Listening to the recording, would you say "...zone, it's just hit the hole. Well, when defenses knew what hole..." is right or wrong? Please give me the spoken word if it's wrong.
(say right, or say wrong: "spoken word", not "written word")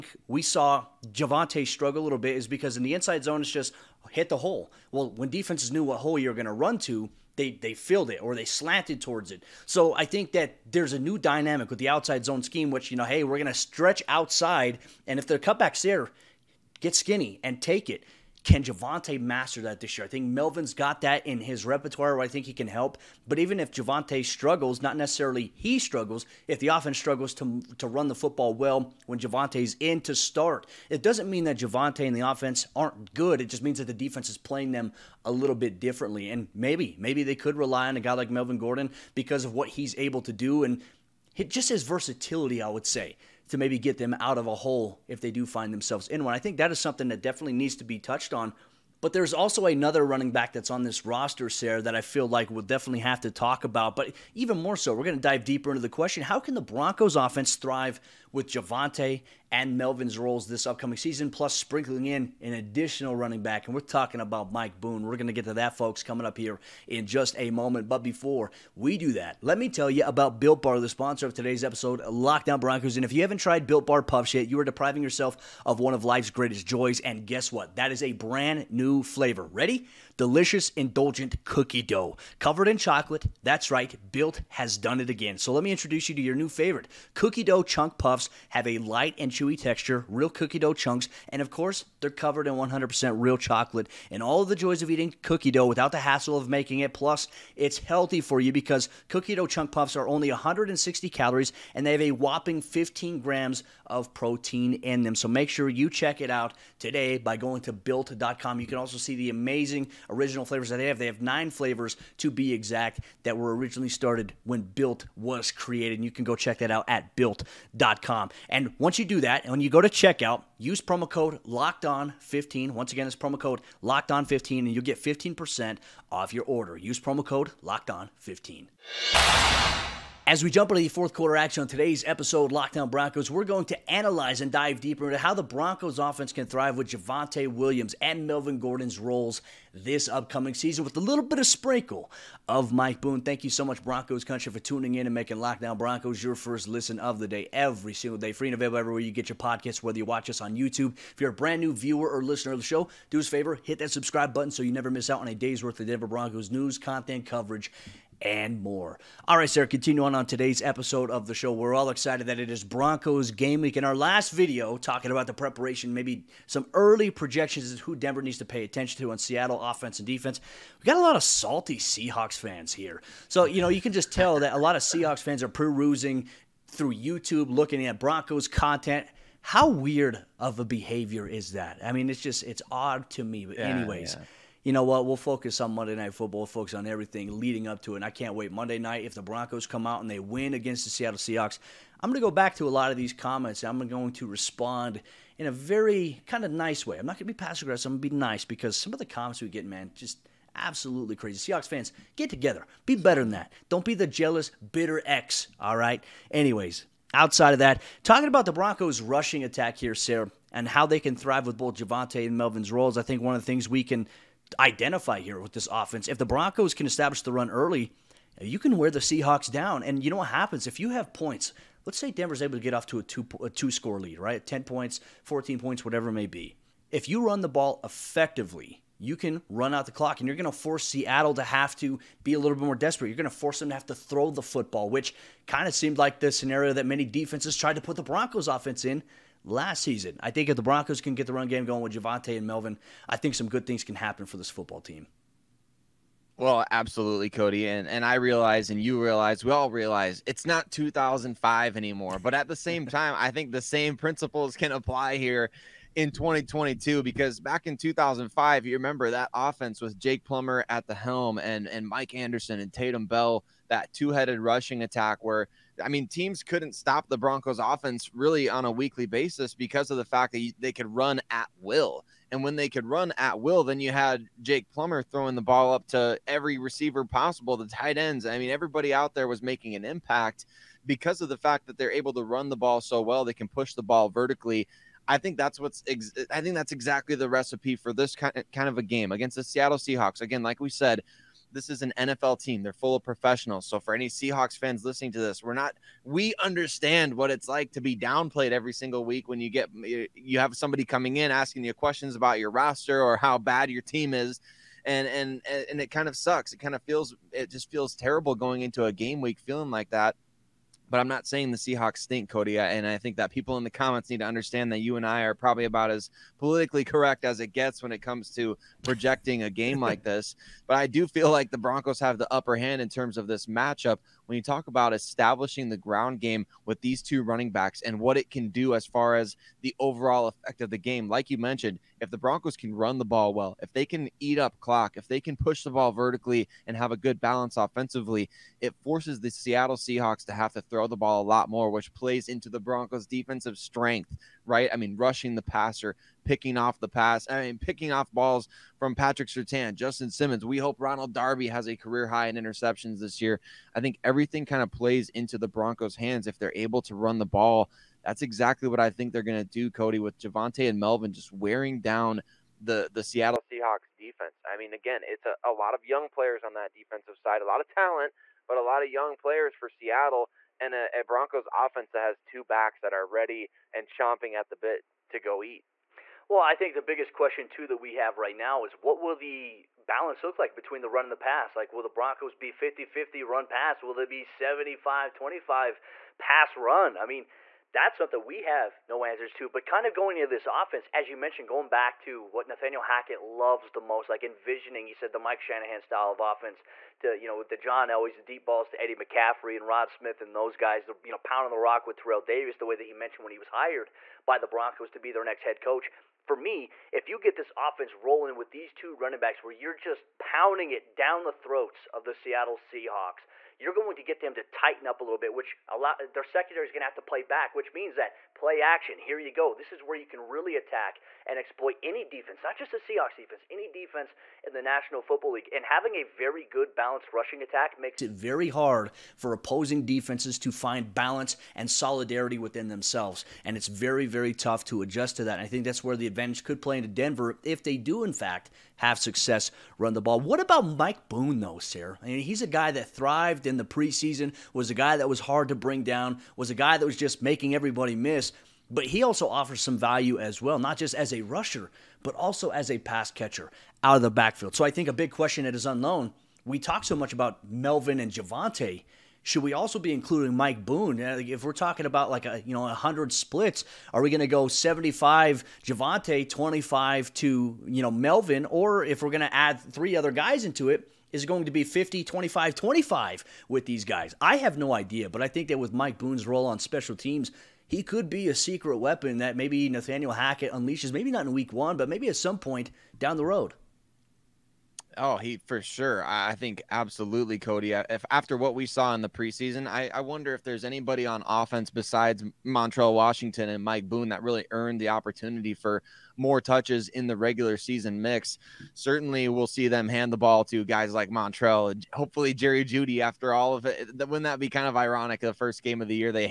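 right.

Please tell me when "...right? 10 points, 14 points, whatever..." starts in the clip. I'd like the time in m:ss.
3:44.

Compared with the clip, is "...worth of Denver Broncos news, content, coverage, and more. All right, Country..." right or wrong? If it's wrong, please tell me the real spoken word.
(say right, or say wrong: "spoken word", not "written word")
wrong: "Sayre", not "Country".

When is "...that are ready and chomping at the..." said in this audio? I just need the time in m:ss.
6:12.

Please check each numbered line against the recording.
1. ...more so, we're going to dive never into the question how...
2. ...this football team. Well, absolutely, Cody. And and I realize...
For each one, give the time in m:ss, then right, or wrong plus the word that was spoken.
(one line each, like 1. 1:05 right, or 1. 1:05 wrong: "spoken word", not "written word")
1. 0:54 wrong: "deeper", not "never"
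2. 4:04 right.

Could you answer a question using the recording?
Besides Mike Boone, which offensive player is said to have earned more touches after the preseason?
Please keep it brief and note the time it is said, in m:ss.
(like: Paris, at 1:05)
Montrell Washington, at 8:12.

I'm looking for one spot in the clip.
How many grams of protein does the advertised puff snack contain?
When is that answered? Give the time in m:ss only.
1:42.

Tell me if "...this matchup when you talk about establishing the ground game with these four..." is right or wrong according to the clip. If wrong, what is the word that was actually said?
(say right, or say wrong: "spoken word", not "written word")
wrong: "two", not "four".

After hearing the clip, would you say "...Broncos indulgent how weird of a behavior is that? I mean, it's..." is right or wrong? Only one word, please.
wrong.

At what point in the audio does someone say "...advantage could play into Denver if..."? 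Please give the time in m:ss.
7:16.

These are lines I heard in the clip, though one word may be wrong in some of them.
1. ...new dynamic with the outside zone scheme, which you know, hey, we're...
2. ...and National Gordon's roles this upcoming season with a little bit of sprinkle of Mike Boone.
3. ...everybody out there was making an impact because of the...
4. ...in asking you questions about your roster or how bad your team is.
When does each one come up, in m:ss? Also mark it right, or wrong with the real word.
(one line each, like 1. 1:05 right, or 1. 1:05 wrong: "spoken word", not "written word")
1. 0:10 right
2. 2:18 wrong: "Melvin", not "National"
3. 4:38 right
4. 5:01 right.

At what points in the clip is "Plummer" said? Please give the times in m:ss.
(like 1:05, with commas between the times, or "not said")
4:20, 4:34.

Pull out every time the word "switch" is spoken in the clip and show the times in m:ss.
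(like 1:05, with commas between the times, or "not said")
not said.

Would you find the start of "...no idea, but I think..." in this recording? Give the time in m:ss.
7:54.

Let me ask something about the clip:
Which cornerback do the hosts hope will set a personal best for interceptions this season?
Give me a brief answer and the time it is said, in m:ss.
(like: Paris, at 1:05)
Ronald Darby, at 5:50.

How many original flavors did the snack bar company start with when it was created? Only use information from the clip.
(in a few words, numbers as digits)
9.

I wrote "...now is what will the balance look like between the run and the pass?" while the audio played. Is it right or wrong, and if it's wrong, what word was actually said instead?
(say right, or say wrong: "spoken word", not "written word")
right.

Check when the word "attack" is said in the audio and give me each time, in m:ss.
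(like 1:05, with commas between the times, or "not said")
3:29, 4:24, 7:00, 7:07.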